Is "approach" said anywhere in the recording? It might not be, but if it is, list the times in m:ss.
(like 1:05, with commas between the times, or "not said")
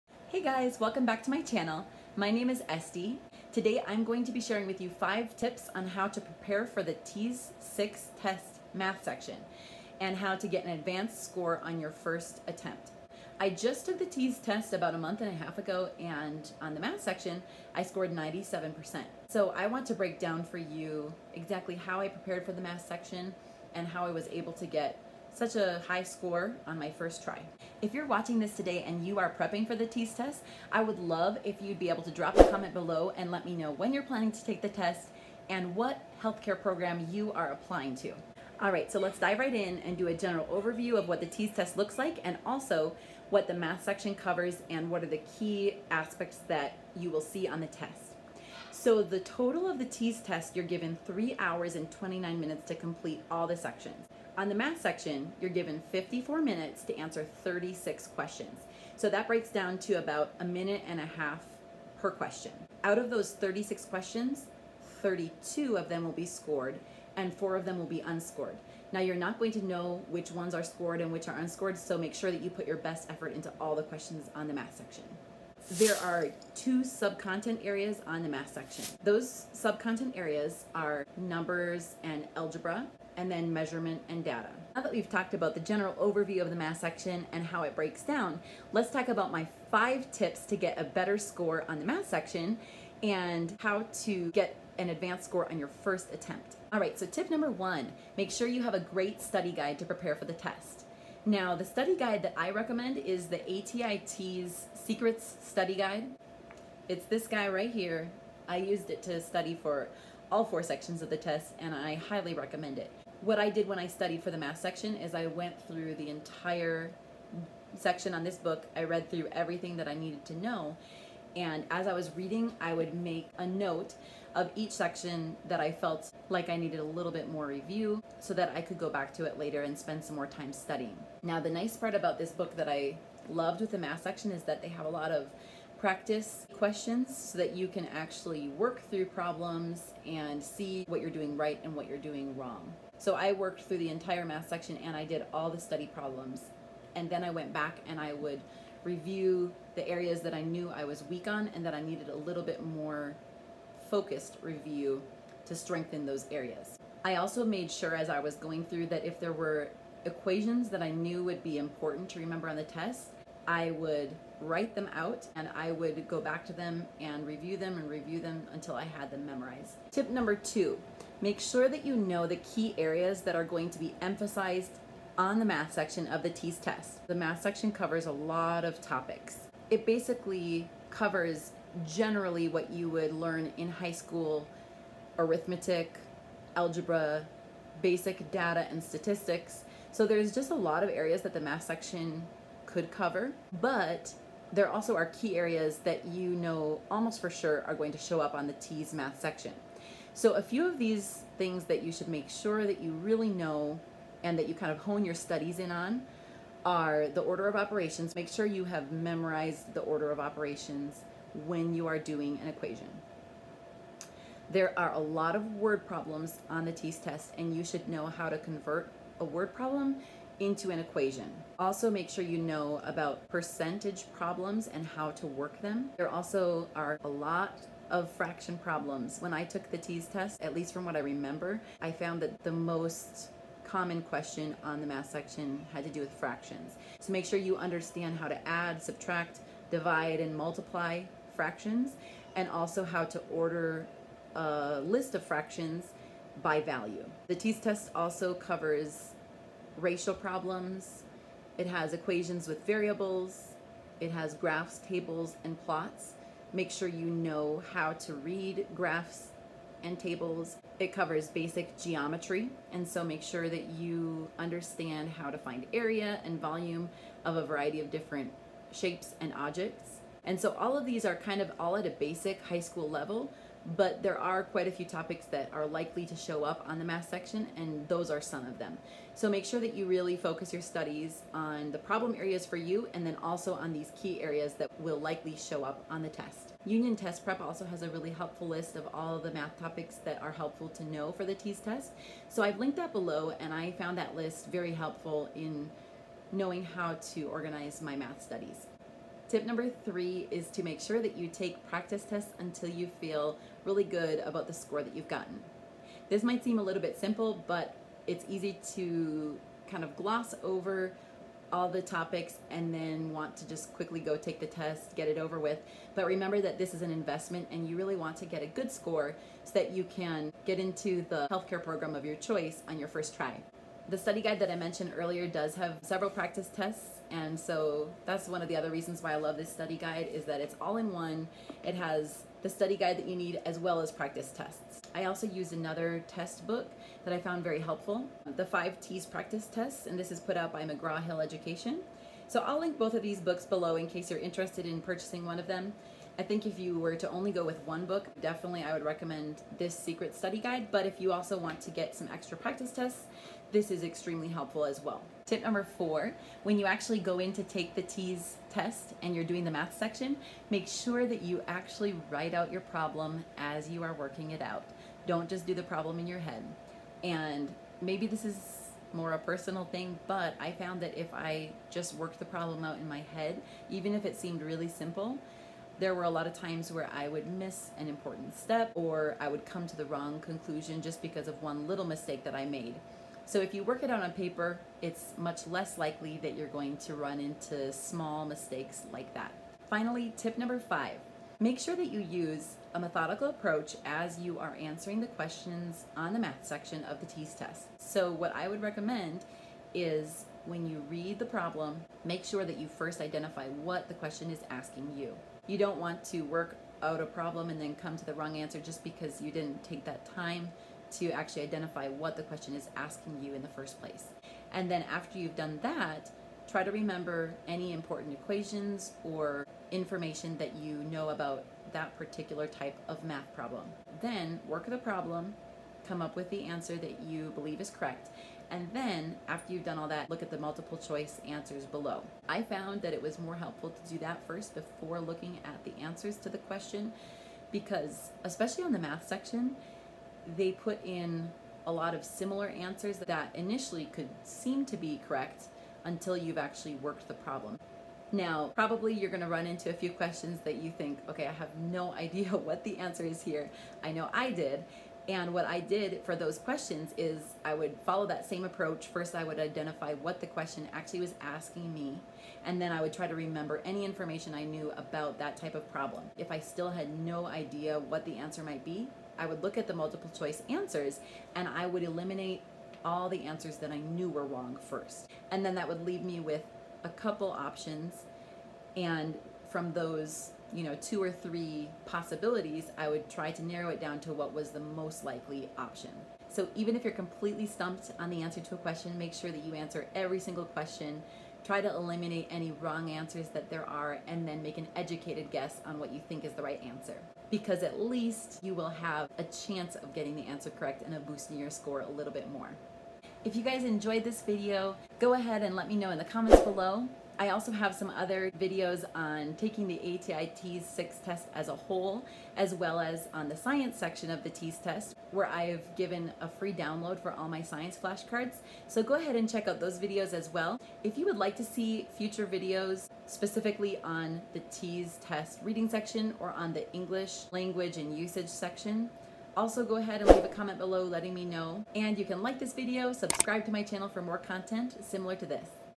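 6:33, 7:38.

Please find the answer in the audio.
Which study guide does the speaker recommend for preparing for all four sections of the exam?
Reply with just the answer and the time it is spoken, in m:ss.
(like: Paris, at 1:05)
ATI TEAS Secrets Study Guide, at 1:43.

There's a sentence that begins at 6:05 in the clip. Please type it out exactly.
Don't just do the problem in your head.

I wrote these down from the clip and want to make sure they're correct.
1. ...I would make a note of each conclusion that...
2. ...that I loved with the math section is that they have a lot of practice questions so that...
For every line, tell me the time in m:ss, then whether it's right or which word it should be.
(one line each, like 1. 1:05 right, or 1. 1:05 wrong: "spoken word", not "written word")
1. 2:02 wrong: "section", not "conclusion"
2. 2:12 right.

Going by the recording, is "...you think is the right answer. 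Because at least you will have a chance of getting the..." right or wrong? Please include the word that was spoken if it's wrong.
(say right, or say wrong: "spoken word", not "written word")
right.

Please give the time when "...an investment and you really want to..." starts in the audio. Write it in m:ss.
5:16.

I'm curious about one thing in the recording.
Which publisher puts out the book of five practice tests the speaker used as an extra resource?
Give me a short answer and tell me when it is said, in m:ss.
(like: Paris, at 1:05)
McGraw-Hill Education, at 5:40.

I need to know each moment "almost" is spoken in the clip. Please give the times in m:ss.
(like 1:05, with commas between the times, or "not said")
3:16.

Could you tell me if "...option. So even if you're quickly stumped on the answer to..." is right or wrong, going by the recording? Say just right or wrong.
wrong.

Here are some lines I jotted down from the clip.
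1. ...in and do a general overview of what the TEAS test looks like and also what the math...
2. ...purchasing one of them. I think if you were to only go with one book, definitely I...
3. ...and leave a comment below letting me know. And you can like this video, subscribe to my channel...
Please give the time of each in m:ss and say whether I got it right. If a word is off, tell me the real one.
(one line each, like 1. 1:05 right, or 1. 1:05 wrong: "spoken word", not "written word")
1. 0:39 right
2. 5:44 right
3. 8:50 right.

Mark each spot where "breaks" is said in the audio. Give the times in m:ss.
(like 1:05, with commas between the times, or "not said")
0:19, 0:59, 1:27.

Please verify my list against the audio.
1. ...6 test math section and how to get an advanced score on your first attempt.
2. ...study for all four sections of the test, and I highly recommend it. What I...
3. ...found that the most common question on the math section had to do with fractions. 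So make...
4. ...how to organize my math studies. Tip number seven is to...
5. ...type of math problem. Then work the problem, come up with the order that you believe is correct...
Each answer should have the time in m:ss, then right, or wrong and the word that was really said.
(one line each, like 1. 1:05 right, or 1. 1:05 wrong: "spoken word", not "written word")
1. 0:07 right
2. 1:49 right
3. 3:51 right
4. 4:56 wrong: "three", not "seven"
5. 7:02 wrong: "answer", not "order".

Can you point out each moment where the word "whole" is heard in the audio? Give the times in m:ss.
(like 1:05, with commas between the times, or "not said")
8:31.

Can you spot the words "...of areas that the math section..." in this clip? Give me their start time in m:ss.
3:10.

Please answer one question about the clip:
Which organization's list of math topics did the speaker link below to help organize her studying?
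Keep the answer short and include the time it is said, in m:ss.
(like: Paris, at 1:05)
Union Test Prep, at 4:46.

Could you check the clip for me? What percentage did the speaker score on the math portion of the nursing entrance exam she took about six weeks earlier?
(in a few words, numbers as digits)
97%.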